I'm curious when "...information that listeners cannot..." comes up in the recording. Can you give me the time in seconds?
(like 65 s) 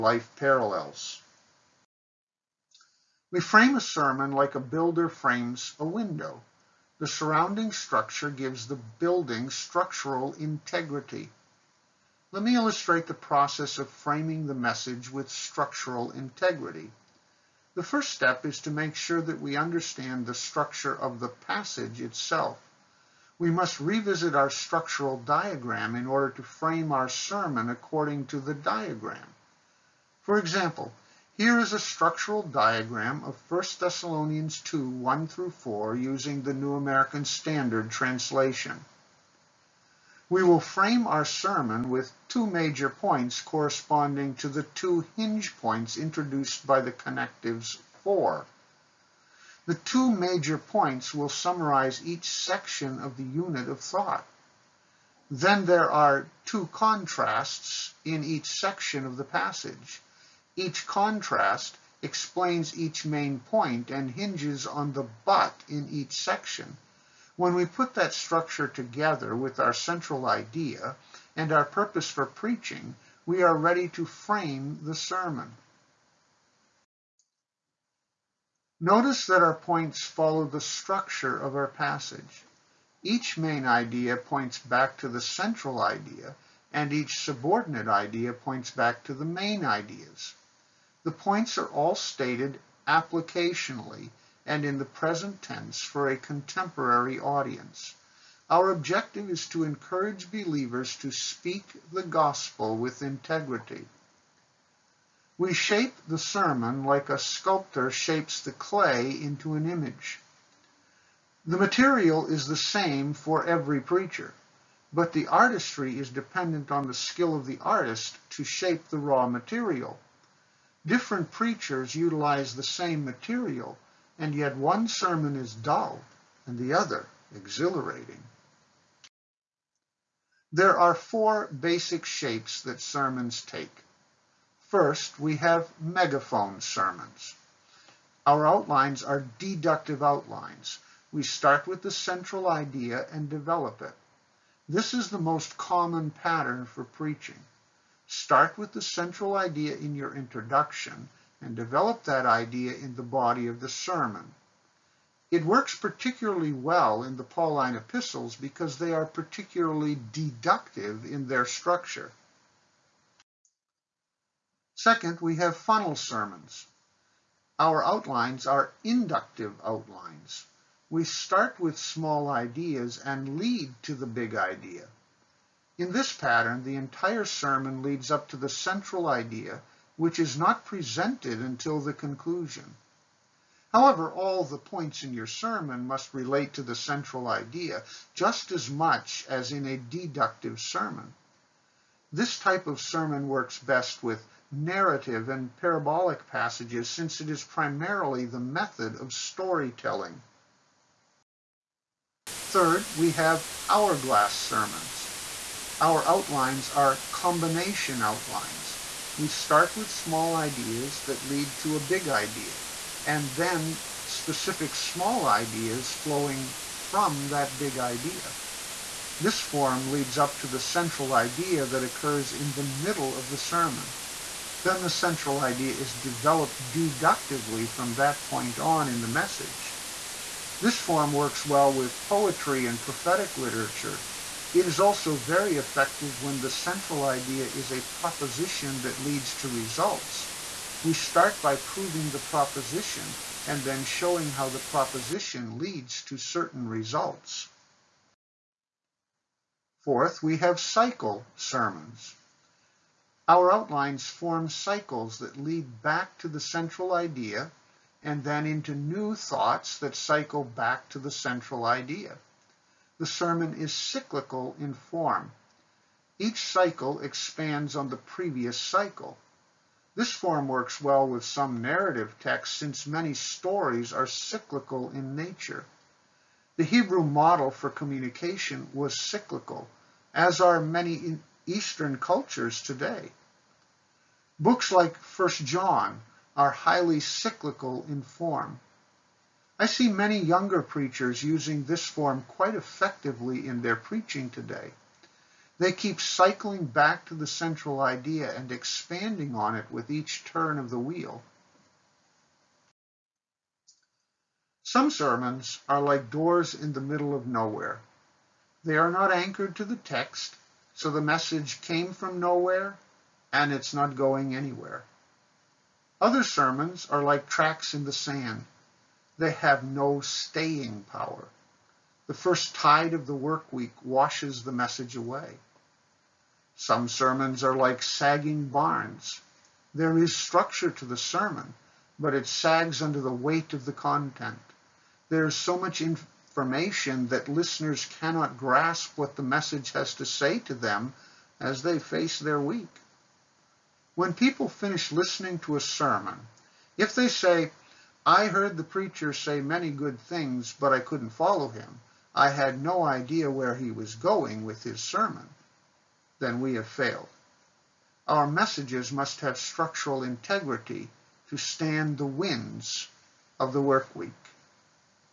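335 s.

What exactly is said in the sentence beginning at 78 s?
Notice that our points follow the structure of our passage.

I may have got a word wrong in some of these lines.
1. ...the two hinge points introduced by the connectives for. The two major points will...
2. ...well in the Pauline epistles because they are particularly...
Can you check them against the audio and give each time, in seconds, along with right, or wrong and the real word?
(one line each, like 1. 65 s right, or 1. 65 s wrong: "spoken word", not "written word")
1. 44 s right
2. 156 s right.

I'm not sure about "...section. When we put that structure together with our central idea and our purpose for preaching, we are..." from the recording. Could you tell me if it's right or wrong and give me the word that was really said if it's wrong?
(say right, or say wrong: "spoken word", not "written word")
right.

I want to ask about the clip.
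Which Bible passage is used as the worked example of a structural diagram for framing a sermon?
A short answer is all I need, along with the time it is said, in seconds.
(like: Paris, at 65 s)
1 Thessalonians 2:1-4, at 33 s.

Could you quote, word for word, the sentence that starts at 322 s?
The first tide of the work week washes the message away.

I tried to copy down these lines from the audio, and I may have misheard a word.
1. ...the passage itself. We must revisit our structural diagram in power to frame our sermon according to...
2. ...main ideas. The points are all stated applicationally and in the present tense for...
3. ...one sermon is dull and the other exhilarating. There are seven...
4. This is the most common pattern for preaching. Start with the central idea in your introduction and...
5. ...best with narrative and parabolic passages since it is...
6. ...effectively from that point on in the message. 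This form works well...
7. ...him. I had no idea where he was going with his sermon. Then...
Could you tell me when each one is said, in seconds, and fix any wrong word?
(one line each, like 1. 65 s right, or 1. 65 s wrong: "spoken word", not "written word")
1. 21 s wrong: "order", not "power"
2. 89 s right
3. 124 s wrong: "four", not "seven"
4. 144 s right
5. 193 s right
6. 226 s wrong: "deductively", not "effectively"
7. 351 s right.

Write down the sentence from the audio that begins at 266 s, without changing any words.
Each cycle expands on the previous cycle.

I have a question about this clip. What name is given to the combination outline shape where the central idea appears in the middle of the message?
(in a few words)
hourglass sermons.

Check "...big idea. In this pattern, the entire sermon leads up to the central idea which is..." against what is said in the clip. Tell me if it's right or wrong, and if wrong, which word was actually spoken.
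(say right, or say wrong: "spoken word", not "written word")
right.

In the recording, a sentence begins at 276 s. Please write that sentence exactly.
The Hebrew model for communication was cyclical, as are many Eastern cultures today.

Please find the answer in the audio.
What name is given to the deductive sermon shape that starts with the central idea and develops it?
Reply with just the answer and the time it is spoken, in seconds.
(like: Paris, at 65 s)
megaphone sermons, at 135 s.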